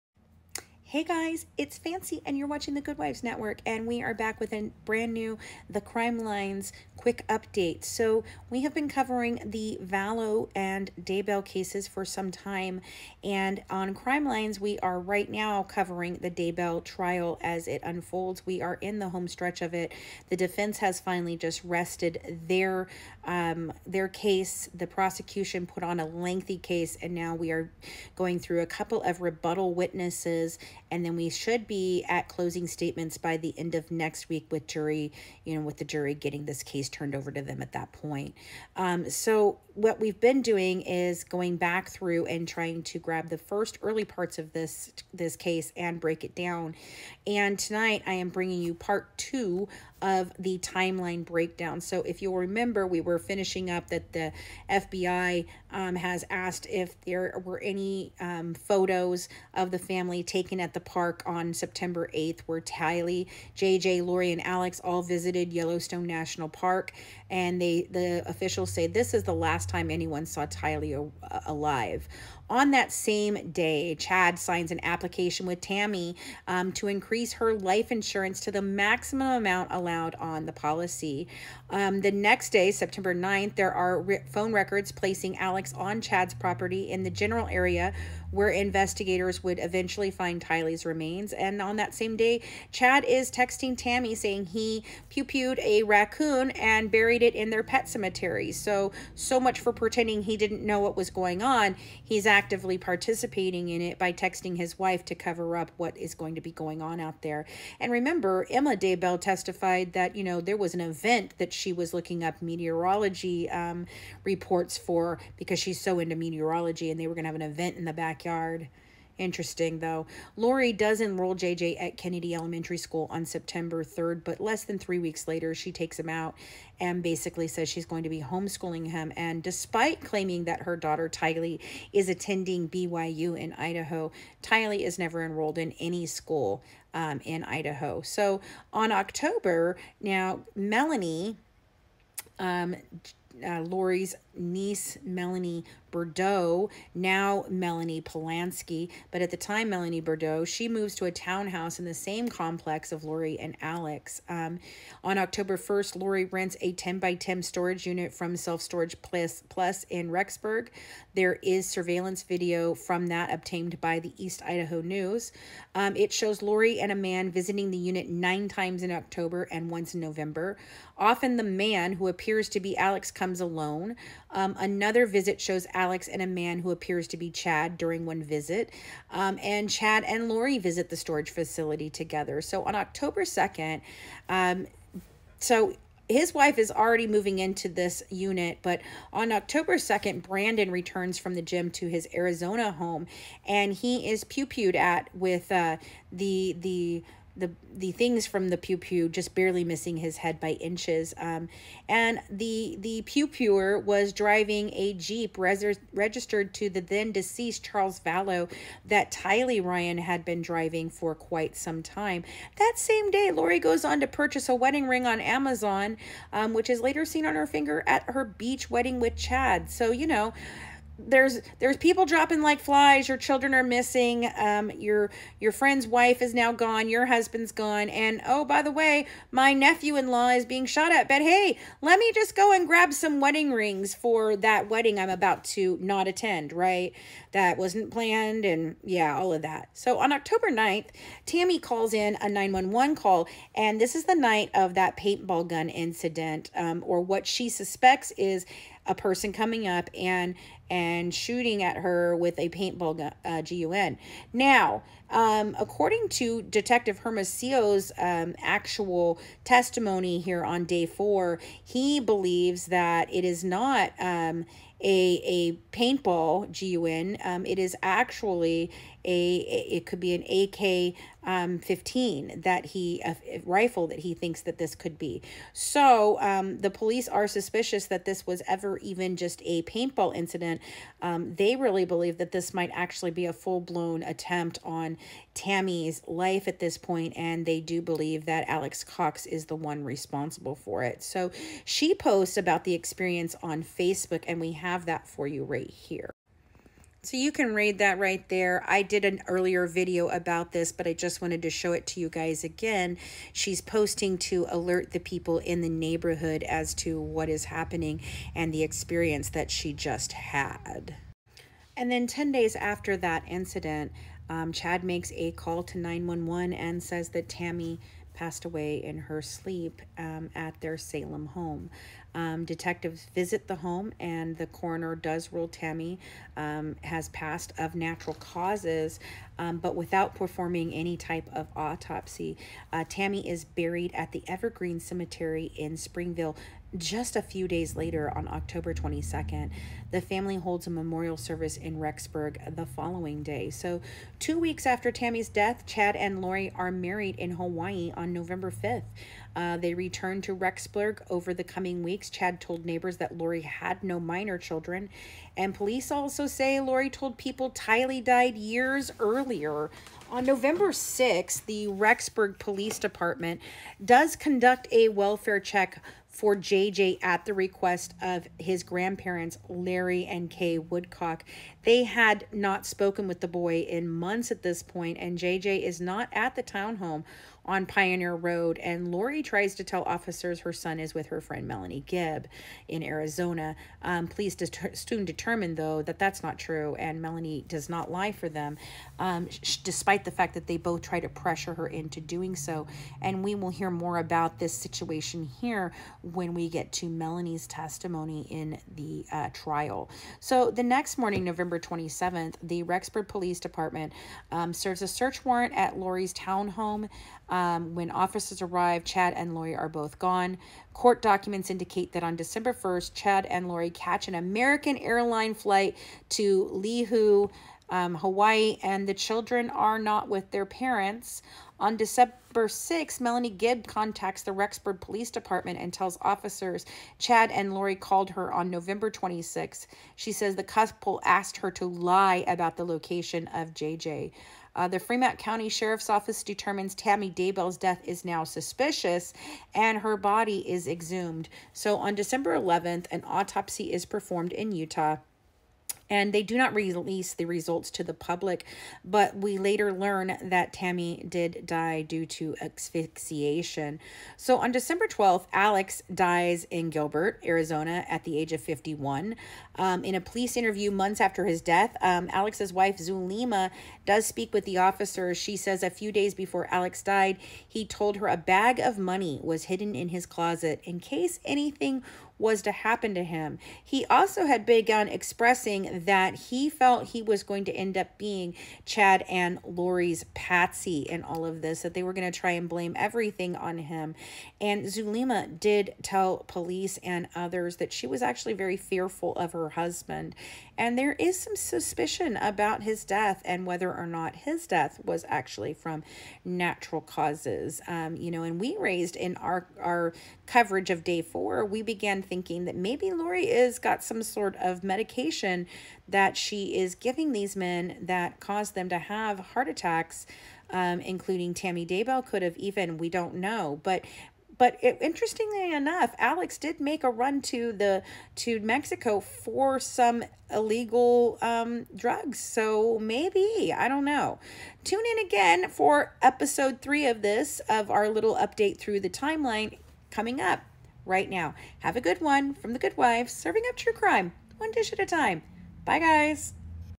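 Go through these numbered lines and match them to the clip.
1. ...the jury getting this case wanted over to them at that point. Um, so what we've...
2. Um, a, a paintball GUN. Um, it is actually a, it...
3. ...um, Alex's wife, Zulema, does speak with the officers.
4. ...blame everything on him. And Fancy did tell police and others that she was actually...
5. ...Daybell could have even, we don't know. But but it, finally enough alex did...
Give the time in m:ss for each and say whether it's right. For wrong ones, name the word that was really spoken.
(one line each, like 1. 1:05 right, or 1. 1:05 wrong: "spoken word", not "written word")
1. 0:35 wrong: "turned", not "wanted"
2. 4:23 right
3. 7:41 right
4. 8:02 wrong: "Zulema", not "Fancy"
5. 8:31 wrong: "interestingly", not "finally".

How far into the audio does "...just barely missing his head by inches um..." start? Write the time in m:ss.
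3:19.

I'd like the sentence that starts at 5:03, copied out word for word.
She's posting to alert the people in the neighborhood as to what is happening and the experience that she just had.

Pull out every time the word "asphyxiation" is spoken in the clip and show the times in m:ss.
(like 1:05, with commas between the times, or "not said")
7:32.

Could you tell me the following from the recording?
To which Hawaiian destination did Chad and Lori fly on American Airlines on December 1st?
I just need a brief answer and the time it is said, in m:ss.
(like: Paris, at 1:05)
Lihue, at 6:56.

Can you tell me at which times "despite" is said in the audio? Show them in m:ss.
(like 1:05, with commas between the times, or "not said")
2:09, 6:29.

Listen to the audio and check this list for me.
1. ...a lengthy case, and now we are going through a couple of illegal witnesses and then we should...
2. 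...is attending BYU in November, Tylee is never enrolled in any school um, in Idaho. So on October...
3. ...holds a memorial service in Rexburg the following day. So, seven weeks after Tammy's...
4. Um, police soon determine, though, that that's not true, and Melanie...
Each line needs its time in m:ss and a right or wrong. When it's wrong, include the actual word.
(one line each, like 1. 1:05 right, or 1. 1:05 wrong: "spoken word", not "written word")
1. 0:26 wrong: "rebuttal", not "illegal"
2. 2:11 wrong: "Idaho", not "November"
3. 5:40 wrong: "two", not "seven"
4. 6:23 right.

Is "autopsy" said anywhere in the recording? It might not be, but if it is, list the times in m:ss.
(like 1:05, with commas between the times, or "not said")
5:31, 7:23.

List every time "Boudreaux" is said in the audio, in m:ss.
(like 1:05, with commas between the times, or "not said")
2:25, 2:30.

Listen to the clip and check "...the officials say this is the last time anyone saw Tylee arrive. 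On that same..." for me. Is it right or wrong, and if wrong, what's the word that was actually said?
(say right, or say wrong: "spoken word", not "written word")
wrong: "alive", not "arrive".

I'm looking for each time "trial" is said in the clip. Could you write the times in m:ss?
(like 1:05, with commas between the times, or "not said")
0:16, 6:39.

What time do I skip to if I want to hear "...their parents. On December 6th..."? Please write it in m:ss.
7:00.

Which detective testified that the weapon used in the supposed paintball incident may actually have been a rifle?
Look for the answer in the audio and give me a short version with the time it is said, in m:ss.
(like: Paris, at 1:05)
Detective Hermosillo, at 4:16.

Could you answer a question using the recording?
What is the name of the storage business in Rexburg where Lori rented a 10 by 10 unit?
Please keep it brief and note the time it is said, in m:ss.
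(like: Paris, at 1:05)
Self Storage Plus, at 2:38.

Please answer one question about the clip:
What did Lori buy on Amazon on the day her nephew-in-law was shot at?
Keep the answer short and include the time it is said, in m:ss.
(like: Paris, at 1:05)
Wedding ring, at 3:34.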